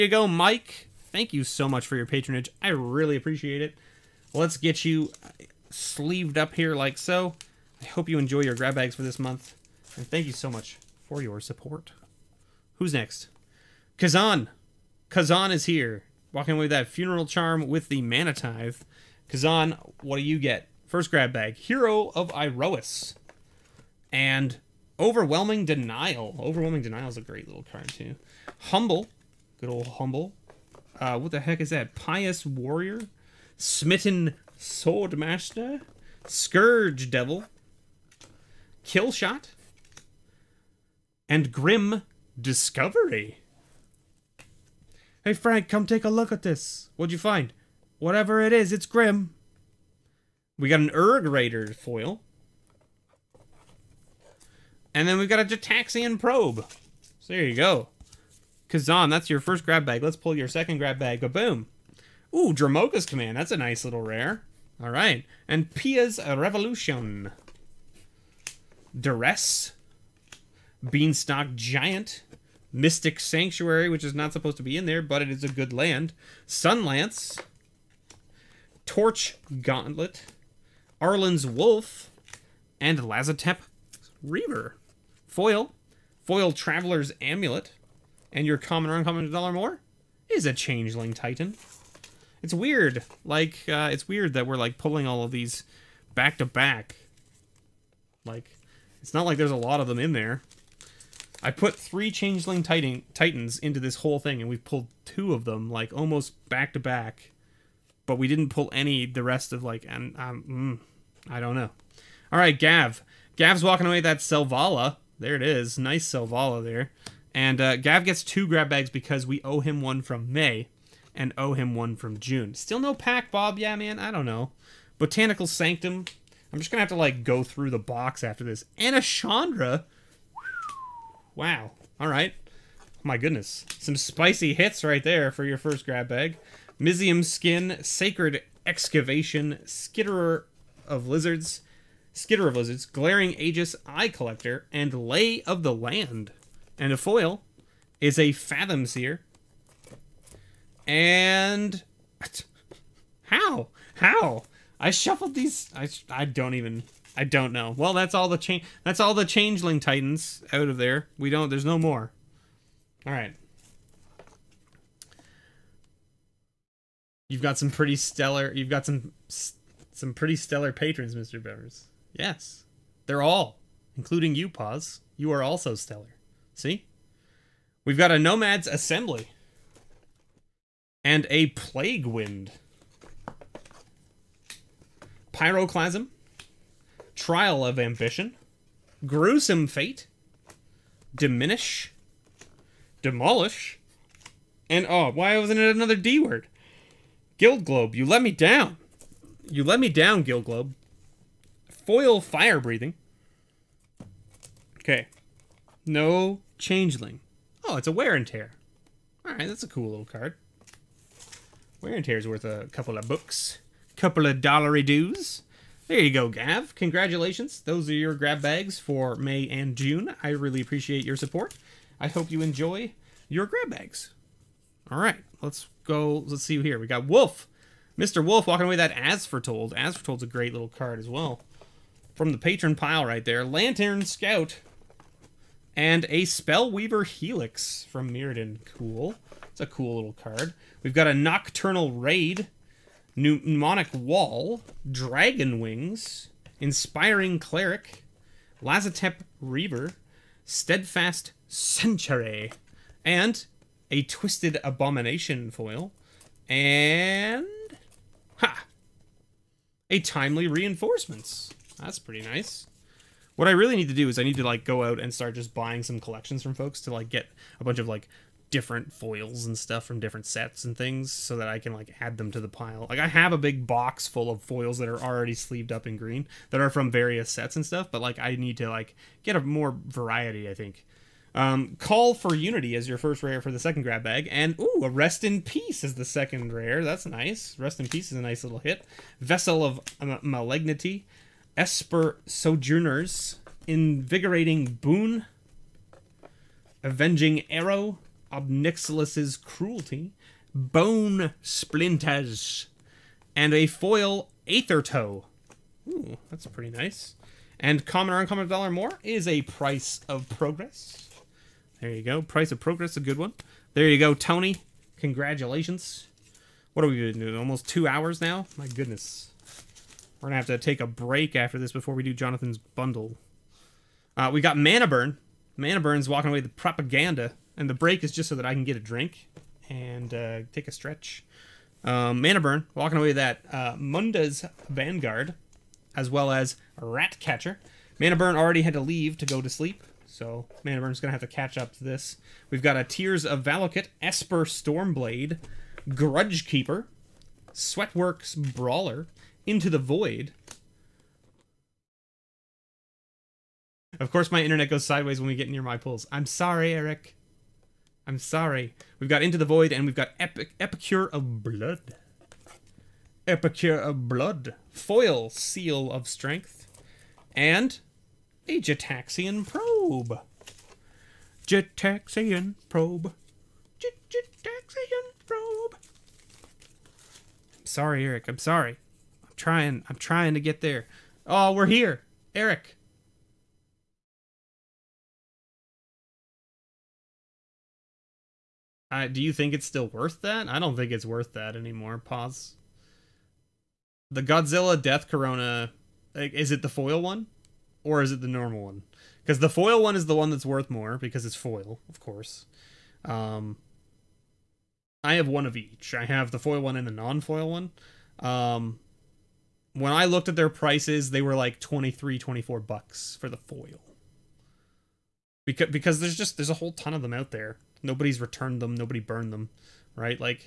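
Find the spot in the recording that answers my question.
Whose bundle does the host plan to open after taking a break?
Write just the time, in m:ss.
5:22.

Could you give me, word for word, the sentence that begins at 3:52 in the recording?
From the patron pile right there.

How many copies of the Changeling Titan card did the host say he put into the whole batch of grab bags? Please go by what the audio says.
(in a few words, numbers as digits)
3.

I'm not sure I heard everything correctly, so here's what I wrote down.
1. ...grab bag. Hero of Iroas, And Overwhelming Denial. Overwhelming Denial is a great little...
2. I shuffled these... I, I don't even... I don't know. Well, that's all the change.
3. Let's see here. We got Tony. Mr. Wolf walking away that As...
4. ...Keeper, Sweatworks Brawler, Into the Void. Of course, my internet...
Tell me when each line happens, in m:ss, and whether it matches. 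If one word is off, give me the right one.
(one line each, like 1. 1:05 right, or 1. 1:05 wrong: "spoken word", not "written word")
1. 0:21 right
2. 2:34 right
3. 3:46 wrong: "Wolf", not "Tony"
4. 5:46 right.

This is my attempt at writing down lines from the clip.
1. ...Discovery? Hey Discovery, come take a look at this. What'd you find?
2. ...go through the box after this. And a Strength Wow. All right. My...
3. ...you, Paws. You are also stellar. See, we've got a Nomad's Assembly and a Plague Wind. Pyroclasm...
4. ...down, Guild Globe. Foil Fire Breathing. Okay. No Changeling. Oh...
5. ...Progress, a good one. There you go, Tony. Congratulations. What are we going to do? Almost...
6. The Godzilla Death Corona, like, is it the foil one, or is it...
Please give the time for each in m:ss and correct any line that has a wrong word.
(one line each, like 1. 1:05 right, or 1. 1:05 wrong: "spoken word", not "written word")
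1. 0:42 wrong: "Frank", not "Discovery"
2. 2:07 wrong: "Chandra", not "Strength"
3. 2:54 right
4. 3:19 right
5. 5:12 right
6. 6:34 right.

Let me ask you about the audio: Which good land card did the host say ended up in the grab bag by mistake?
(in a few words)
Mystic Sanctuary.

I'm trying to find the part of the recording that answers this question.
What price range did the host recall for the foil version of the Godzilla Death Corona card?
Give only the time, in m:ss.
6:51.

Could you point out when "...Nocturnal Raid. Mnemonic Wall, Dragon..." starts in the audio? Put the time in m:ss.
4:01.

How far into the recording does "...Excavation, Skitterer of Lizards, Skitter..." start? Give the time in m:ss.
2:18.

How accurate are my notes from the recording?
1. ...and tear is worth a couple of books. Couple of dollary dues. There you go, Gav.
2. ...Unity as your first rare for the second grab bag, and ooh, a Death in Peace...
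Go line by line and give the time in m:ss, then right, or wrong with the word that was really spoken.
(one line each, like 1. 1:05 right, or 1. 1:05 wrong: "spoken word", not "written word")
1. 3:31 right
2. 4:42 wrong: "Rest", not "Death".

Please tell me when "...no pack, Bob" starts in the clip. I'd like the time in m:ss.
2:02.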